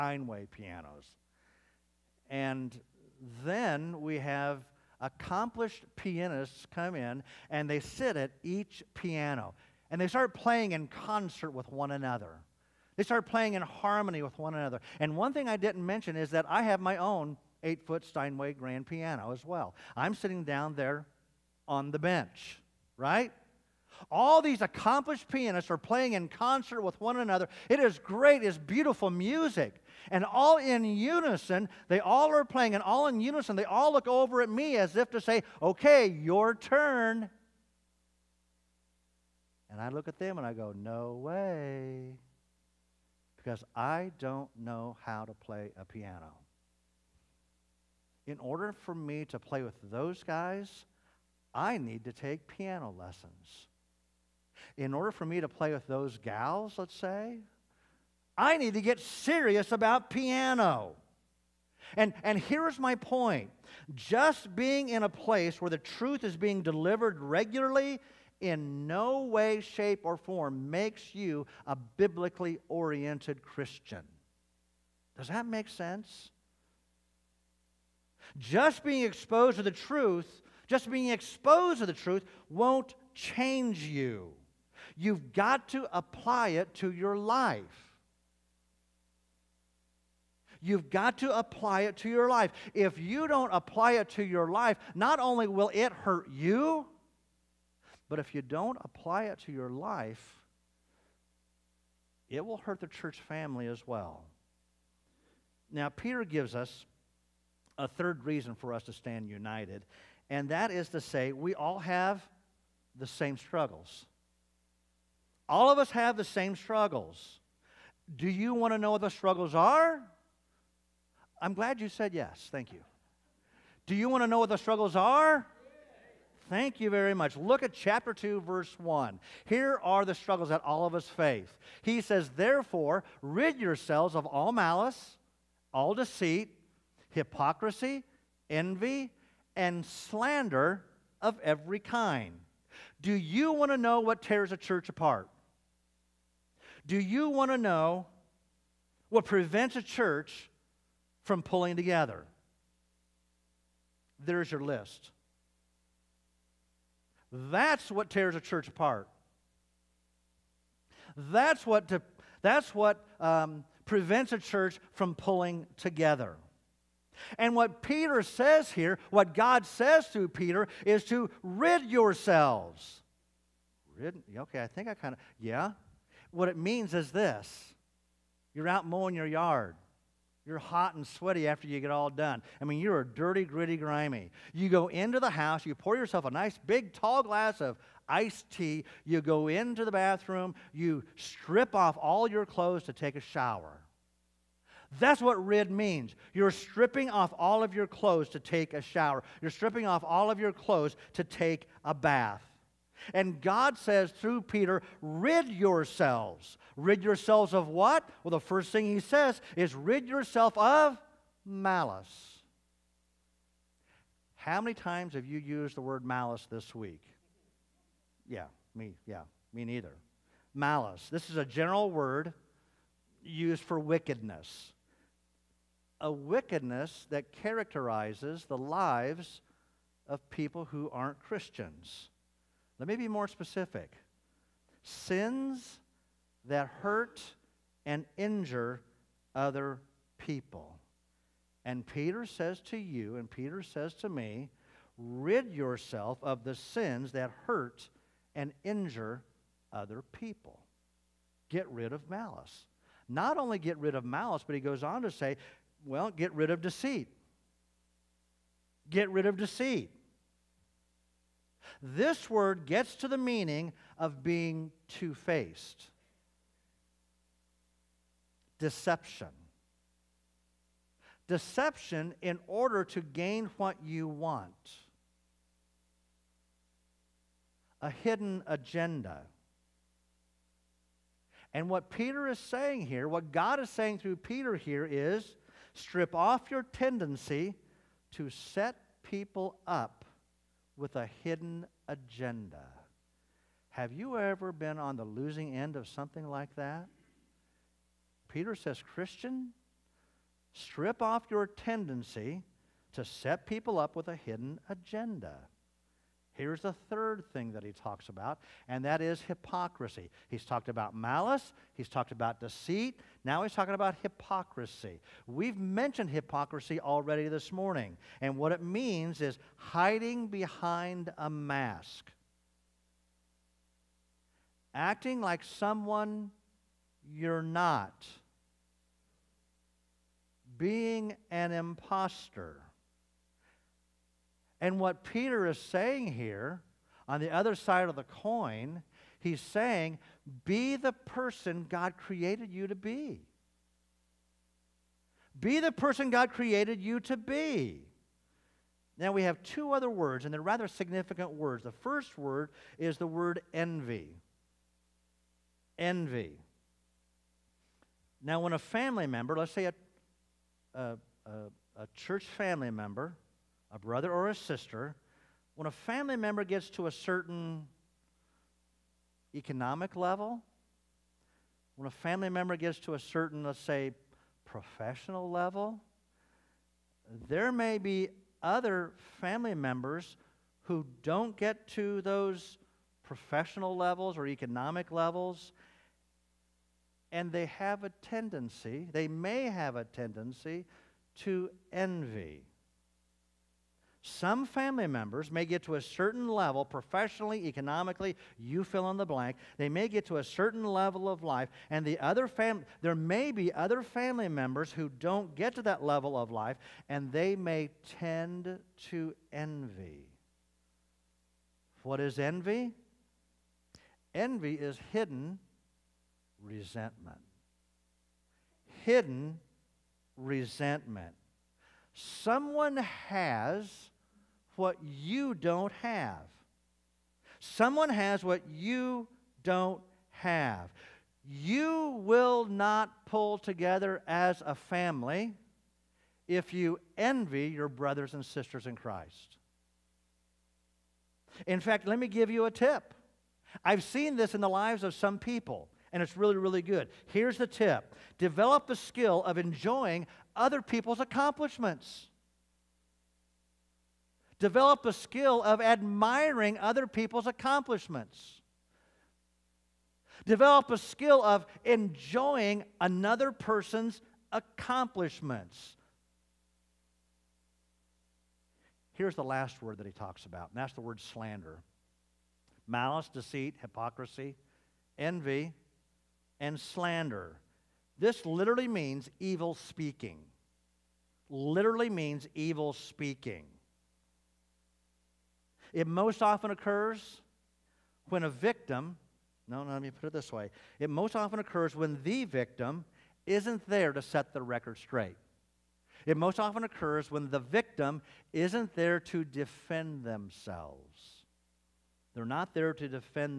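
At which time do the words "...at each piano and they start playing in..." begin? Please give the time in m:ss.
0:08.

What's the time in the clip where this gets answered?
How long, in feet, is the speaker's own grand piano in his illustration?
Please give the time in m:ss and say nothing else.
0:17.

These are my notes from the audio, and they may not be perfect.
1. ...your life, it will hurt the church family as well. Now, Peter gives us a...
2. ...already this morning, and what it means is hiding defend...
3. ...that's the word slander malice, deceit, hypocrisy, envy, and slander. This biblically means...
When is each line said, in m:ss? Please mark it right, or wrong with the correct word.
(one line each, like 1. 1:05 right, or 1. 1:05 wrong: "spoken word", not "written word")
1. 1:39 right
2. 5:16 wrong: "behind", not "defend"
3. 7:50 wrong: "literally", not "biblically".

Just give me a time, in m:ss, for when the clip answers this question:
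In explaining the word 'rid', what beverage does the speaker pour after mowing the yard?
3:08.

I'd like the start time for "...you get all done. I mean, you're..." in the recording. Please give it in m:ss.
3:01.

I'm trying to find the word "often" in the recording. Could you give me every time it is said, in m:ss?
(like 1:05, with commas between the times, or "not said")
8:06, 8:11, 8:16.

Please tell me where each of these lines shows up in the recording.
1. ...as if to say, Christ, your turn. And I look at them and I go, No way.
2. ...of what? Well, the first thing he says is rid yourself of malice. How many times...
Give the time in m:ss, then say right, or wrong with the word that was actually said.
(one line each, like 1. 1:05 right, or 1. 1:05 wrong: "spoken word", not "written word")
1. 0:34 wrong: "Okay", not "Christ"
2. 3:27 right.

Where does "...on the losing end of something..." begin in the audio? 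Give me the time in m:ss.
4:54.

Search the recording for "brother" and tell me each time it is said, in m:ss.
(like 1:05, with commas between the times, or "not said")
6:03, 7:17.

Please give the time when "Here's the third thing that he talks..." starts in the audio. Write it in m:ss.
5:06.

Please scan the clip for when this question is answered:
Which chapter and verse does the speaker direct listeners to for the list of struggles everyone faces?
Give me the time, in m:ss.
2:07.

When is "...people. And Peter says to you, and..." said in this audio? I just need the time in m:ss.
4:00.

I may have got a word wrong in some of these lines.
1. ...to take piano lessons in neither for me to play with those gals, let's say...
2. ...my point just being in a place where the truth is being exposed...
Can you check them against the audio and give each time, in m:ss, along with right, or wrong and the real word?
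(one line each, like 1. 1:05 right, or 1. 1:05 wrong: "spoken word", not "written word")
1. 0:52 wrong: "order", not "neither"
2. 1:02 wrong: "delivered", not "exposed".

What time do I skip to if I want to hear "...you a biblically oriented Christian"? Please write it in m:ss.
1:11.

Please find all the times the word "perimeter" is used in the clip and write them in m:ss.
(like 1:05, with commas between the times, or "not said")
not said.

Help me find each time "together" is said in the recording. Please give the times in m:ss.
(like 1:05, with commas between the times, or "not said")
2:31, 2:45, 7:13.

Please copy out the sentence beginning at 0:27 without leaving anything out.
It is great, it's beautiful music.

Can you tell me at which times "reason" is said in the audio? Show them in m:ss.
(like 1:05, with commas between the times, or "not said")
1:48.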